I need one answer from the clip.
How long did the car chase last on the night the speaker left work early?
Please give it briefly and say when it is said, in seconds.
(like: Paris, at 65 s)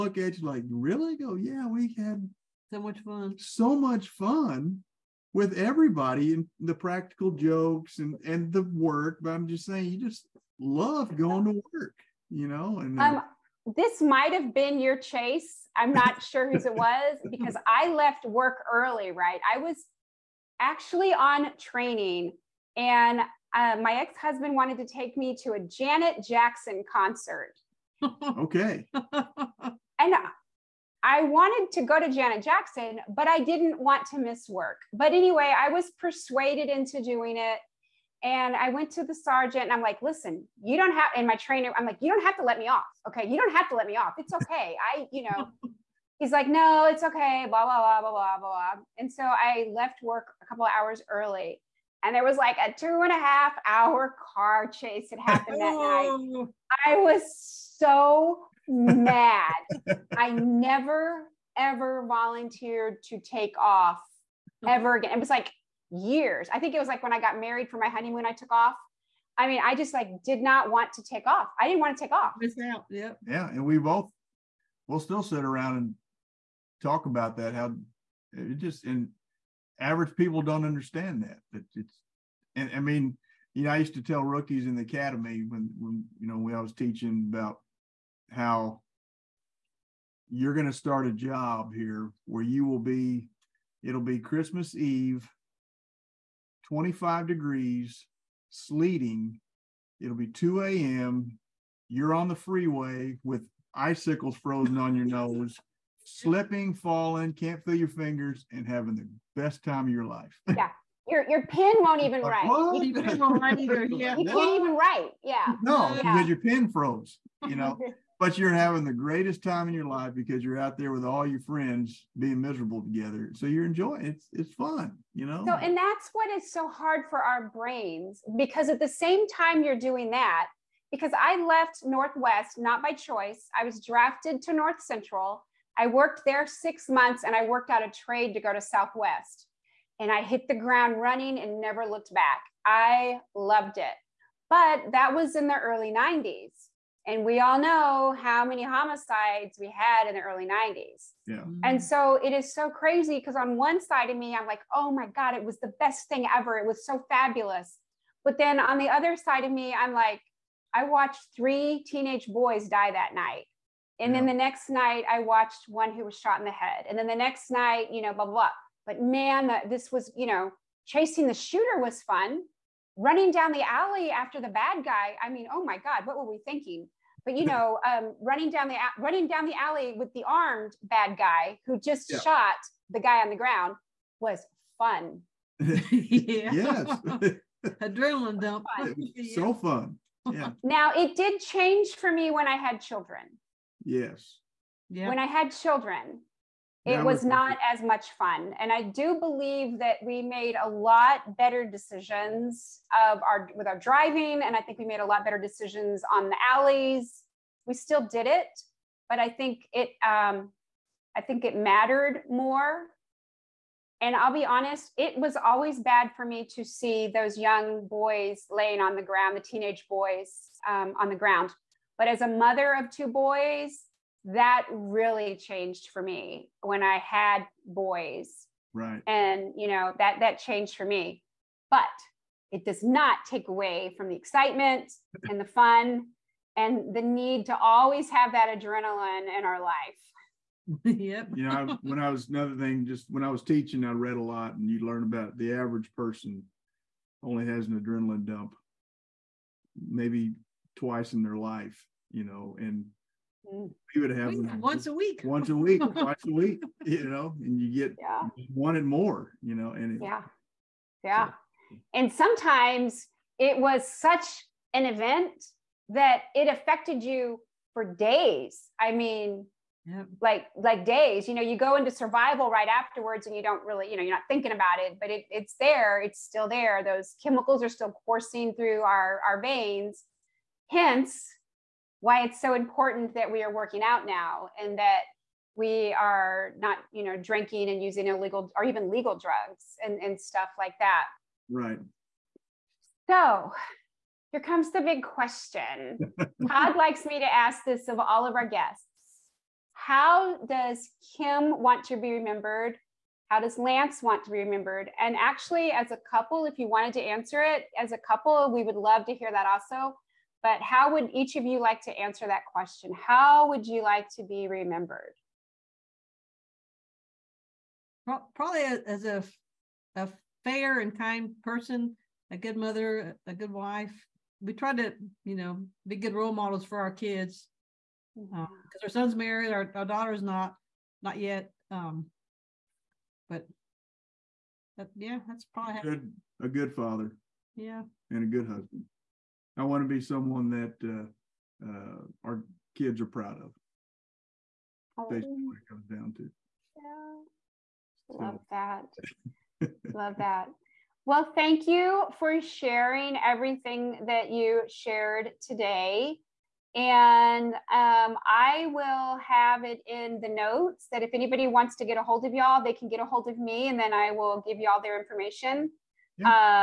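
2.5 hours, at 52 s.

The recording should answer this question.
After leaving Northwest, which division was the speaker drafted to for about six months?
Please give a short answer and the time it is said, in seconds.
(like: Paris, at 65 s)
North Central, at 134 s.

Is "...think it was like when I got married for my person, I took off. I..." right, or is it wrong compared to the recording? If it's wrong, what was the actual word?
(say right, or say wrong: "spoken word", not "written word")
wrong: "honeymoon", not "person".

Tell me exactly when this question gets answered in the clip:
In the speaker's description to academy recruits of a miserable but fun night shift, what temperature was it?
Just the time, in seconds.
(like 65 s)
96 s.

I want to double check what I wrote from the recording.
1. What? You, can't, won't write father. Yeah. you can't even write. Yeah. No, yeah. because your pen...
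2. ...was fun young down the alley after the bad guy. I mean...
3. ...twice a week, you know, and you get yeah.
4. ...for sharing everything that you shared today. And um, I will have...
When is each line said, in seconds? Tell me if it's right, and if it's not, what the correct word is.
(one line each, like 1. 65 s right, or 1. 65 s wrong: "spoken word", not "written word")
1. 112 s wrong: "either", not "father"
2. 171 s wrong: "running", not "young"
3. 255 s right
4. 352 s right.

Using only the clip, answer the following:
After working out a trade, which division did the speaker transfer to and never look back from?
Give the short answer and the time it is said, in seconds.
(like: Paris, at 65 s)
Southwest, at 138 s.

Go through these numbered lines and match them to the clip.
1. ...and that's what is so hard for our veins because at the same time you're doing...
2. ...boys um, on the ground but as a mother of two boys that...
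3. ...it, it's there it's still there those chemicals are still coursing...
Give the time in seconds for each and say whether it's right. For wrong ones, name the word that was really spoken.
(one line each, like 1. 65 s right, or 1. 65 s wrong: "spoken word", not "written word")
1. 125 s wrong: "brains", not "veins"
2. 219 s right
3. 275 s right.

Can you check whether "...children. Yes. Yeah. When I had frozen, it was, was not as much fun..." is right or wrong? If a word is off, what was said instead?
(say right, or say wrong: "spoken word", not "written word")
wrong: "children", not "frozen".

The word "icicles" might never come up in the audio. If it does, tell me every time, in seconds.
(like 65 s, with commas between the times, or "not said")
103 s.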